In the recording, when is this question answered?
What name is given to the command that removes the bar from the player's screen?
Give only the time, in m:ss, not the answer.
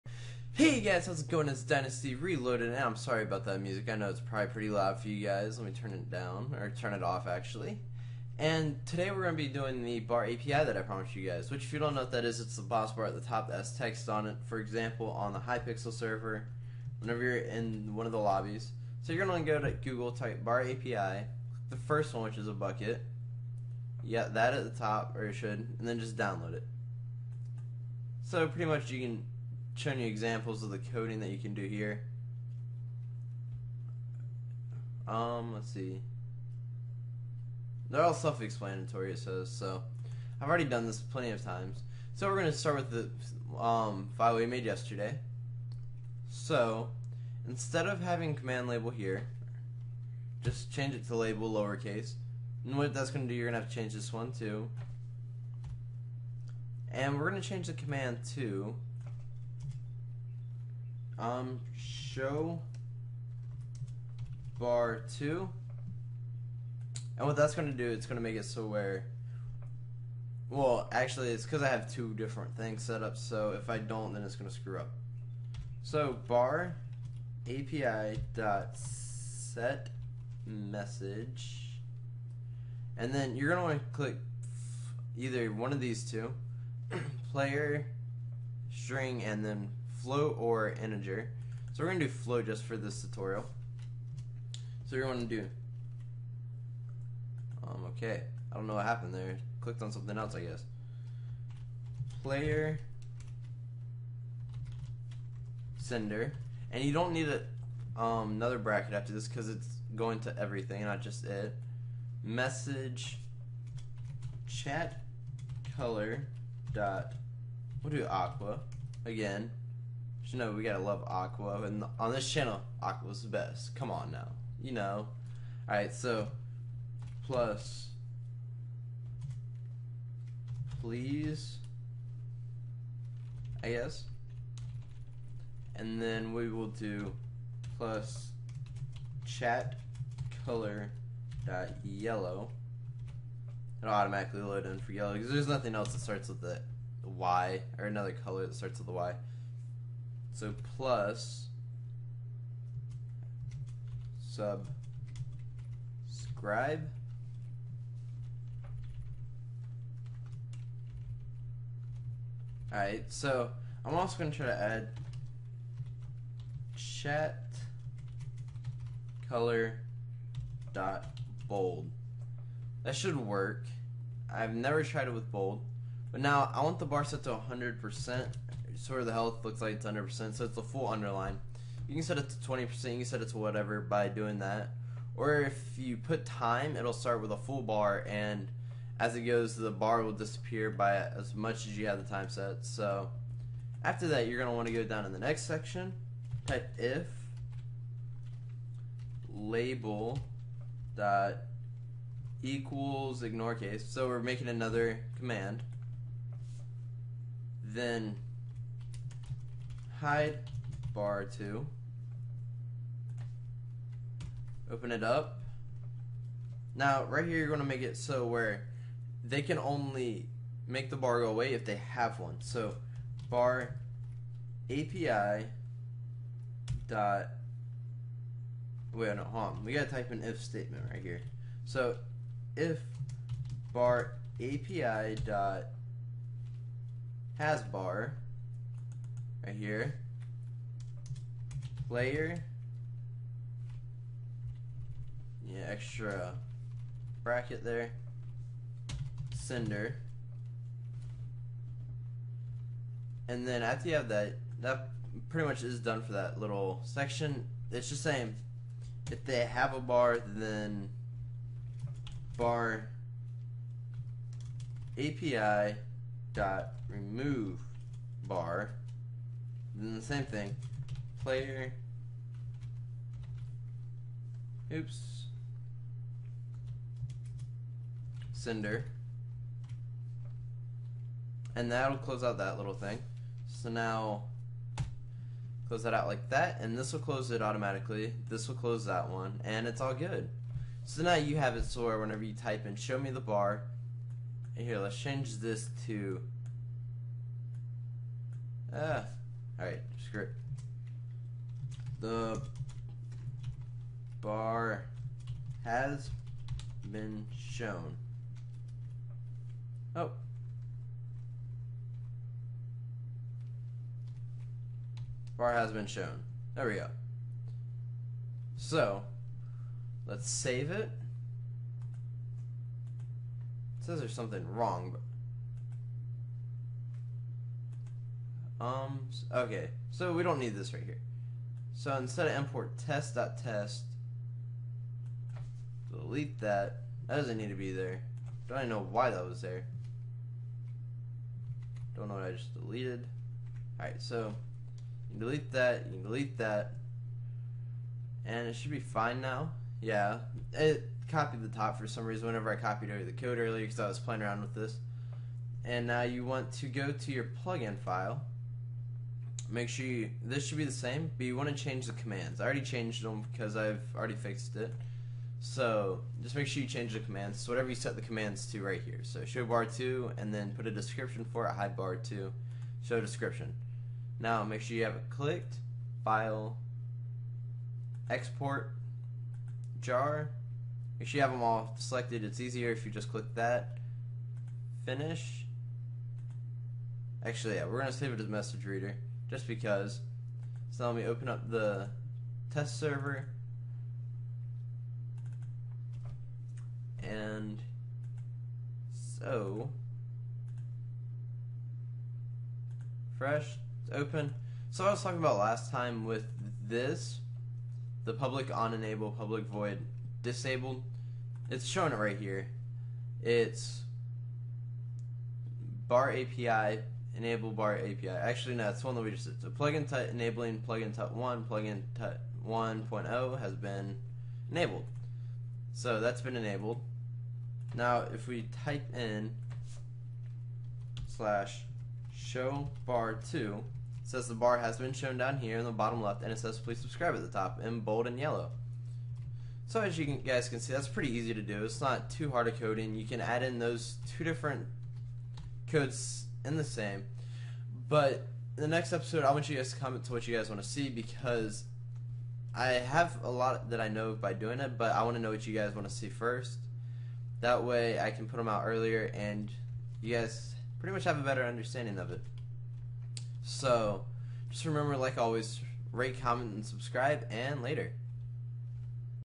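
3:30.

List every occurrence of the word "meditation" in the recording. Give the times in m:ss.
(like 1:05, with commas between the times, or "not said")
not said.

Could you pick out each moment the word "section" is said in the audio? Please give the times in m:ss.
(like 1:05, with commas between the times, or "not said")
3:15, 4:16.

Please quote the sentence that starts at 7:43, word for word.
So, just remember, like always, rate, comment, and subscribe, and later.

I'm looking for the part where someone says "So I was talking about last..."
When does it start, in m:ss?
6:44.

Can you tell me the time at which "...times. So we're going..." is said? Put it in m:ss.
0:41.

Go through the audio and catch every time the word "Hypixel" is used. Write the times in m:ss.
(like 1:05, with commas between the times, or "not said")
0:15.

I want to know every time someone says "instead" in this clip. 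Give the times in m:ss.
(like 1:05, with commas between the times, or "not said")
0:47, 5:31.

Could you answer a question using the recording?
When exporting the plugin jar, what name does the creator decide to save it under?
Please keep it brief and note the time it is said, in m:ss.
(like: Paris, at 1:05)
message reader, at 6:28.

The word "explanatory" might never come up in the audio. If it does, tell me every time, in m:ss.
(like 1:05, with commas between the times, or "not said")
0:38.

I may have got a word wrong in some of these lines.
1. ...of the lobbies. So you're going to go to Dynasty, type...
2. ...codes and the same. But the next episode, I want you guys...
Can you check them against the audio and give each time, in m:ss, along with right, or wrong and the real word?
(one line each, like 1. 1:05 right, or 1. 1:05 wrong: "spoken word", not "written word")
1. 0:18 wrong: "Google", not "Dynasty"
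2. 7:25 right.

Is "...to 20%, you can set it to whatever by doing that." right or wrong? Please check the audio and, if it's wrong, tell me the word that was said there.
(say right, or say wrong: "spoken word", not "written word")
right.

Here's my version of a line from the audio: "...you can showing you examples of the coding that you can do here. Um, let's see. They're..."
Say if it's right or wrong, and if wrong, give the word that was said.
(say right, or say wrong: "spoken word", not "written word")
right.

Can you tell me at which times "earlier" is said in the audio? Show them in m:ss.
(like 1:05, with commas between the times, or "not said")
5:53, 7:38.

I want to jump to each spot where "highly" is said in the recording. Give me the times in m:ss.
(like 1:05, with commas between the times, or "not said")
not said.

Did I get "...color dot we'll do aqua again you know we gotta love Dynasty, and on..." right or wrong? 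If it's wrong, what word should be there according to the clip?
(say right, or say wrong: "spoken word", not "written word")
wrong: "Aqua", not "Dynasty".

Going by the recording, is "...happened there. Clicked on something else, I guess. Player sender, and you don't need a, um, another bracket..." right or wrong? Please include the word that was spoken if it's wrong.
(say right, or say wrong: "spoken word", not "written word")
right.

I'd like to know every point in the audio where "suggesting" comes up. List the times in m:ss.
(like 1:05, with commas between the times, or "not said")
not said.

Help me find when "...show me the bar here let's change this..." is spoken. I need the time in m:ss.
4:52.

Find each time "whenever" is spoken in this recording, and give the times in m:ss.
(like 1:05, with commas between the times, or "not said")
0:16, 4:51, 5:52.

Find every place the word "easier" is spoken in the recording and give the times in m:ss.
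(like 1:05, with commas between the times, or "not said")
6:22.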